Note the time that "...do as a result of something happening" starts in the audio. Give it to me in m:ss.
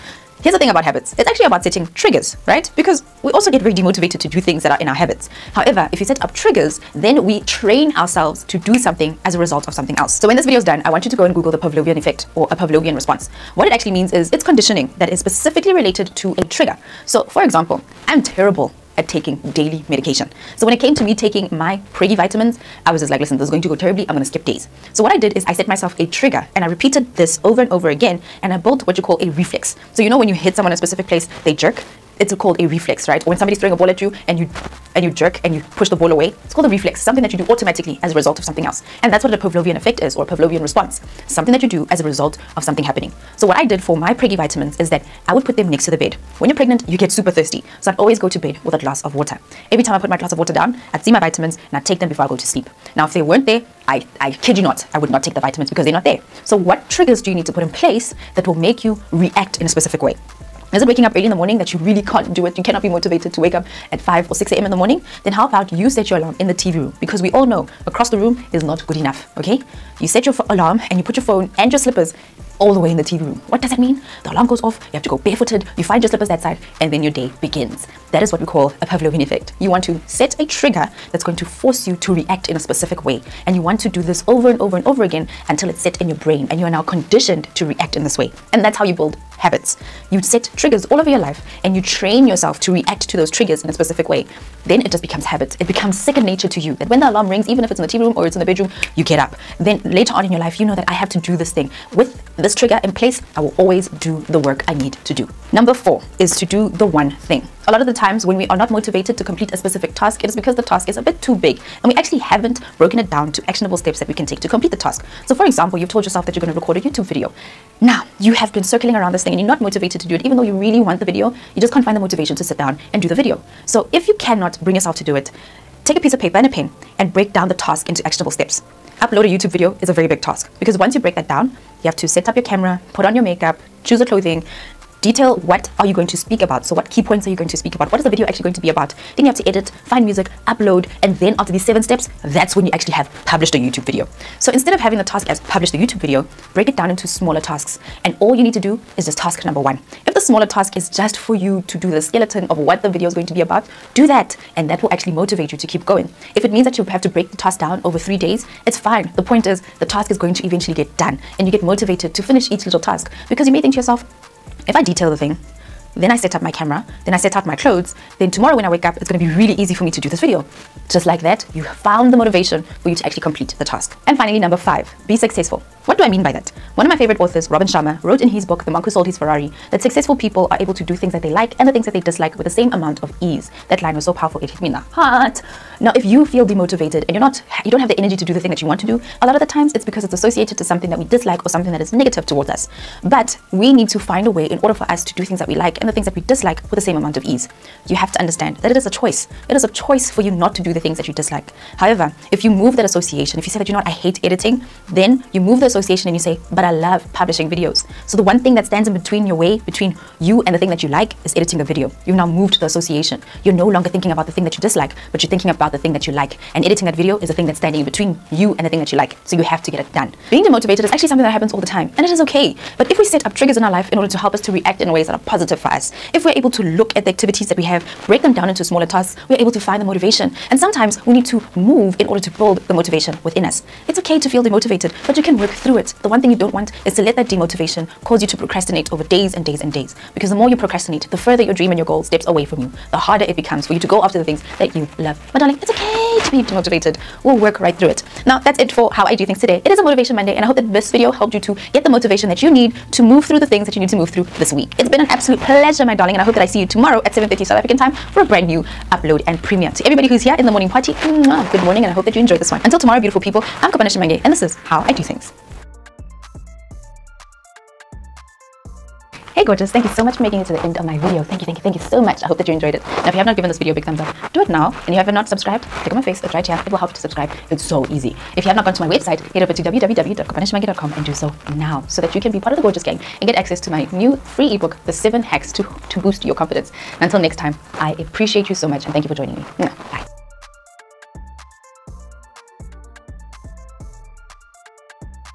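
0:41.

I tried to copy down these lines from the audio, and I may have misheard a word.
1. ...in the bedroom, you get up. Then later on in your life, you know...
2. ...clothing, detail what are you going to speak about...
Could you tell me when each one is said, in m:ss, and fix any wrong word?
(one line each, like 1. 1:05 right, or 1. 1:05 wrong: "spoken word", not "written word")
1. 1:38 right
2. 2:14 right.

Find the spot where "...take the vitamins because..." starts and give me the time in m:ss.
0:55.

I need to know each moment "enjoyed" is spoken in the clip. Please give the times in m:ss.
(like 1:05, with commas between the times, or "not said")
4:22, 4:32.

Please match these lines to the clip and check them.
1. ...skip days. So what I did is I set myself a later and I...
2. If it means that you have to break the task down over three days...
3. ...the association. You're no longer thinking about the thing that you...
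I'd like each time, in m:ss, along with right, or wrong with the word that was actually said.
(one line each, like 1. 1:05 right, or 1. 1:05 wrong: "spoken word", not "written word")
1. 0:24 wrong: "trigger", not "later"
2. 2:36 right
3. 3:32 right.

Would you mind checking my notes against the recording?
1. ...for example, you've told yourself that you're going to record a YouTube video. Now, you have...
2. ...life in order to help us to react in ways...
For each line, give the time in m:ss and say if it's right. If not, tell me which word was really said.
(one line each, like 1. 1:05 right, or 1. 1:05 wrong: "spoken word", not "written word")
1. 1:55 right
2. 3:43 right.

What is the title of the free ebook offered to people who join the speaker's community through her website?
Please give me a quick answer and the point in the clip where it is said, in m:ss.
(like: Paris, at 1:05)
The 7 Hacks to Boost Your Confidence, at 4:44.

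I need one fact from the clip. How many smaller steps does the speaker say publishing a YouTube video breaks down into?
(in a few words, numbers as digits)
7.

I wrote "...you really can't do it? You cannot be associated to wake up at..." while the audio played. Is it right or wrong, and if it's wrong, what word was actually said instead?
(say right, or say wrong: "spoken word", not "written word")
wrong: "motivated", not "associated".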